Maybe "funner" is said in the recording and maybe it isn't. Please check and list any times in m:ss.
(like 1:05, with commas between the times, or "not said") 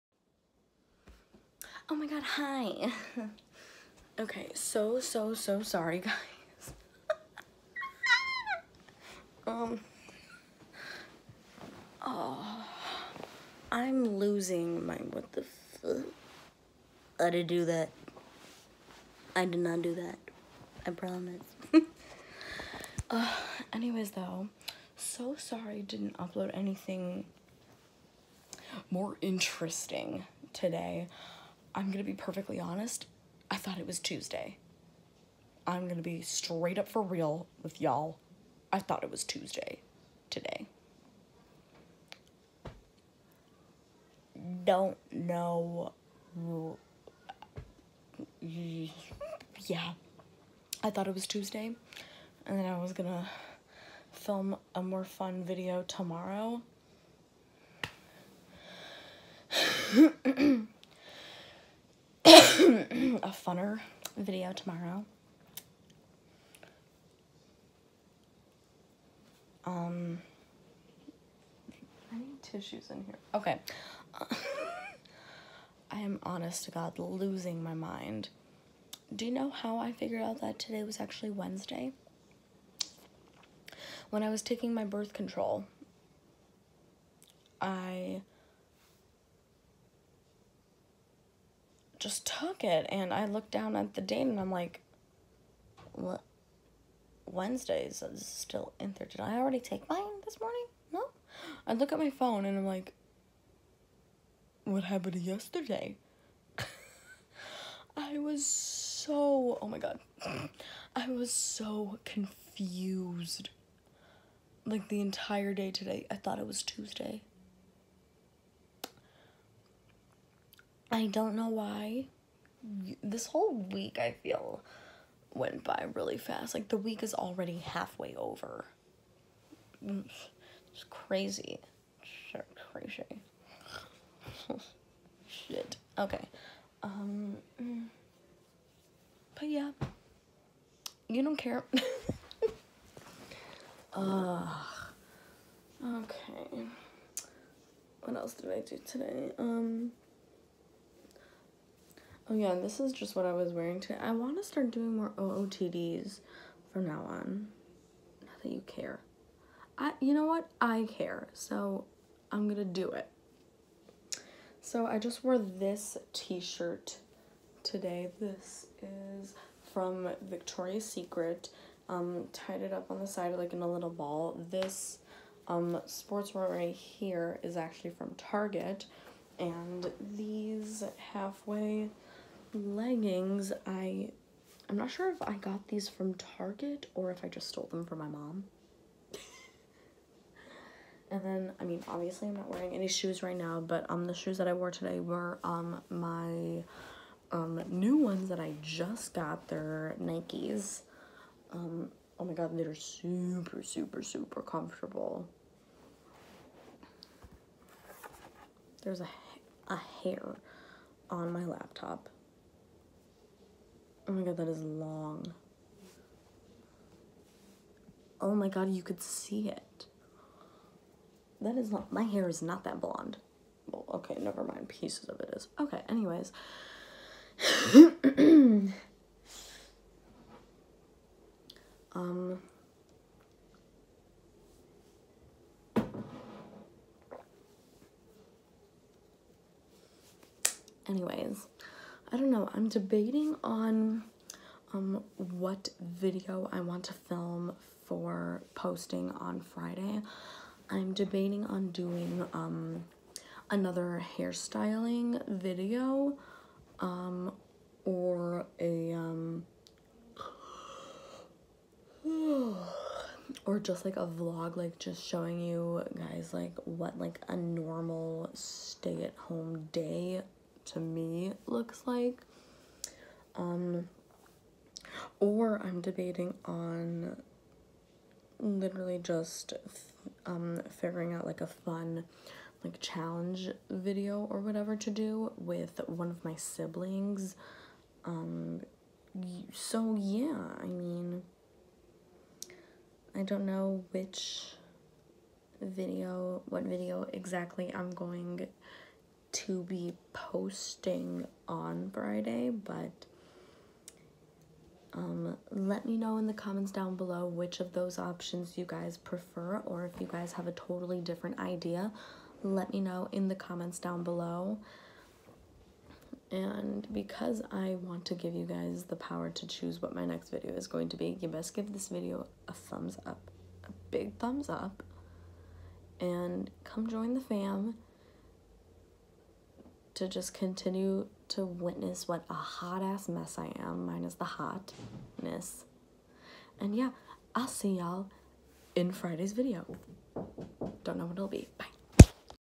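1:03.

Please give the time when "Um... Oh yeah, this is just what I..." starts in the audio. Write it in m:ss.
2:29.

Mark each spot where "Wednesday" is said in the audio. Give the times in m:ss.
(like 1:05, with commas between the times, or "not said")
1:21, 1:37.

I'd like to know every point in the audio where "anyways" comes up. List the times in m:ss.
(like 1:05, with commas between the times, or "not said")
0:23, 3:45, 4:00.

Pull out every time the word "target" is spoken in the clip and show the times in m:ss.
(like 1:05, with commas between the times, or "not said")
2:58, 3:06.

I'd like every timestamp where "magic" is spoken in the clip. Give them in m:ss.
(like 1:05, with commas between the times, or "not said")
not said.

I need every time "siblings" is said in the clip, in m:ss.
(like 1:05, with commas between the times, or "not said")
4:46.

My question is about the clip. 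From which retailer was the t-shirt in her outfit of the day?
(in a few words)
Victoria's Secret.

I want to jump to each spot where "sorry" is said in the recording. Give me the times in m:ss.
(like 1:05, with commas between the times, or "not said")
0:05, 0:25.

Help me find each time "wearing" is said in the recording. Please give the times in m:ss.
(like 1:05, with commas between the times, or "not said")
2:33, 3:12.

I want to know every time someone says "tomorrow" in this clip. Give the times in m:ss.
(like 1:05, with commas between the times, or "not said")
0:55, 1:04.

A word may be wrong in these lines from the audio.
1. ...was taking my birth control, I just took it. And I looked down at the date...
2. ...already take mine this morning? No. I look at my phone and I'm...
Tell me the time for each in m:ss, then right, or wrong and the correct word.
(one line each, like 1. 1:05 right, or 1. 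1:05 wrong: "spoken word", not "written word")
1. 1:24 right
2. 1:39 right.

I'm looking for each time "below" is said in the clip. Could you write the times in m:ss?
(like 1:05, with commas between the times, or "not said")
5:06, 5:14.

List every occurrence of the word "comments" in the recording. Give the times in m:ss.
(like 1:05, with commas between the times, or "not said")
5:06, 5:13.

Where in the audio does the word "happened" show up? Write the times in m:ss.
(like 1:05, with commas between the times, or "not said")
1:44.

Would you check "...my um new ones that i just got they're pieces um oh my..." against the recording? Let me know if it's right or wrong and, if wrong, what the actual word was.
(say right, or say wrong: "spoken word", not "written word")
wrong: "nikes", not "pieces".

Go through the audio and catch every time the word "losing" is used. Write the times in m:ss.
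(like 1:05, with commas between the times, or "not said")
0:14, 1:16.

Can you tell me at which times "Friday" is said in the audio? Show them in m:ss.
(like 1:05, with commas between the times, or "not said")
4:09, 5:01, 5:38.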